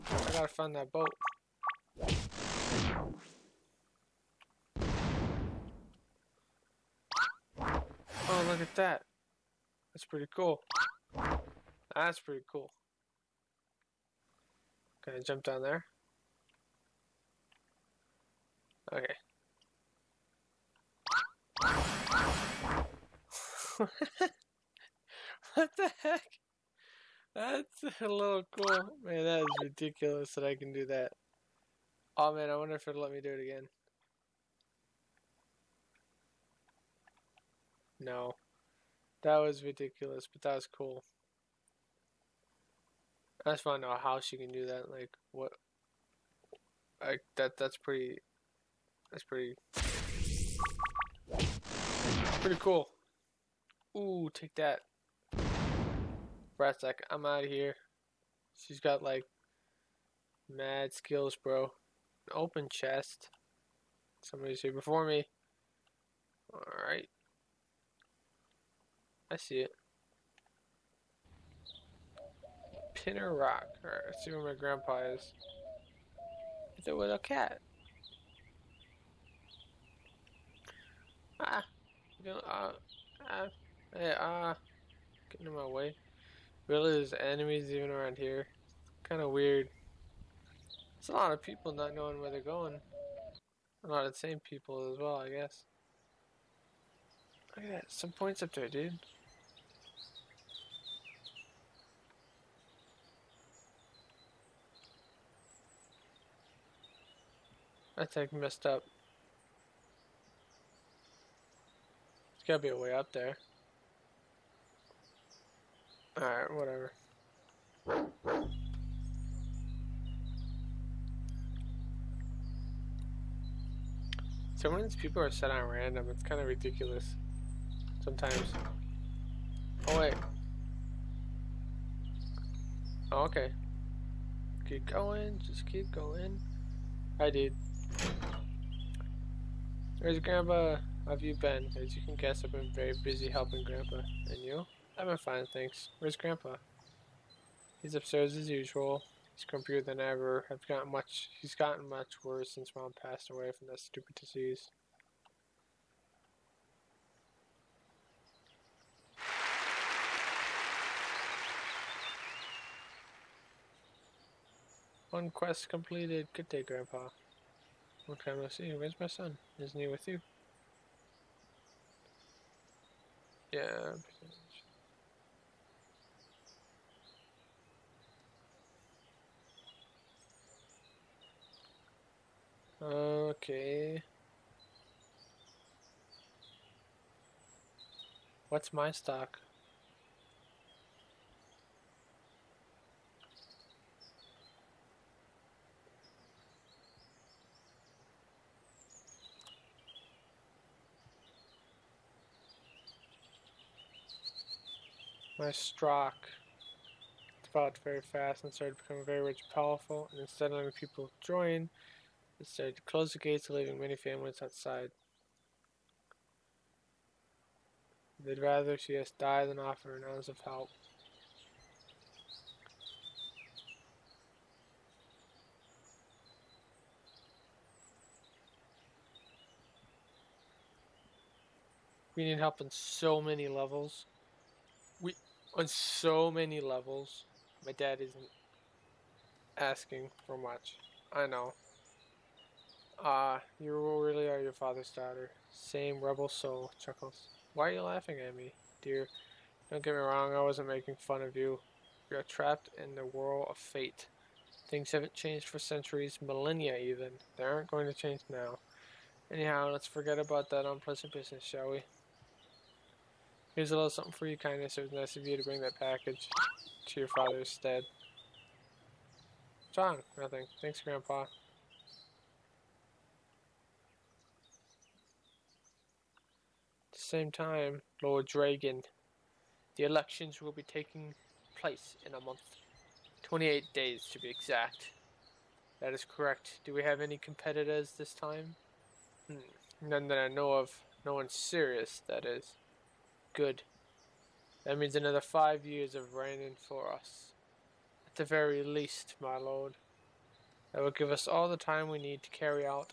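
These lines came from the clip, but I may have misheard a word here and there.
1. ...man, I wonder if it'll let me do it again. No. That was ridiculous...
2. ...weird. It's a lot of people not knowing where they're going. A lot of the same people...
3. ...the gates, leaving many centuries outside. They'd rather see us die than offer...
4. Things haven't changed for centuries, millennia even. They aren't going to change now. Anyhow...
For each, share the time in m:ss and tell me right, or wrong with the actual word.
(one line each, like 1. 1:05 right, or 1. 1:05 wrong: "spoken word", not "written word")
1. 0:32 right
2. 1:29 right
3. 3:33 wrong: "families", not "centuries"
4. 4:14 right.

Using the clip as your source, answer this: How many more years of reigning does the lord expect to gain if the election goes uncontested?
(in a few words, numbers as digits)
5.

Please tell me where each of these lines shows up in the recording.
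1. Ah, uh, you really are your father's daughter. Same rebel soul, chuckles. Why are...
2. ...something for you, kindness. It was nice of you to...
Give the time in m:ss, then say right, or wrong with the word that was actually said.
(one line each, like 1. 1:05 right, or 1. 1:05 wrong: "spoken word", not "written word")
1. 4:03 right
2. 4:23 right.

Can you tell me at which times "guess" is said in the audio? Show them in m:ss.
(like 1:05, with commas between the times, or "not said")
1:35, 2:22.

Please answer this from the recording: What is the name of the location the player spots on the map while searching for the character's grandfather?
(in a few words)
Pinner Rock.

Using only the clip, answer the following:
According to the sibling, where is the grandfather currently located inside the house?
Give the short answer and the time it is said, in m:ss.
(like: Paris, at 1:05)
Upstairs, at 2:27.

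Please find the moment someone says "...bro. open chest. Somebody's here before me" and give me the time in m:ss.
1:01.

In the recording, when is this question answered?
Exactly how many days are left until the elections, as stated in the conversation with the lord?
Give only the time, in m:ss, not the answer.
4:43.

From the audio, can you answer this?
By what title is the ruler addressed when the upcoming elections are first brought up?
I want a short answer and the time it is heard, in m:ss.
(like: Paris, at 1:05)
Lord Dragon, at 4:38.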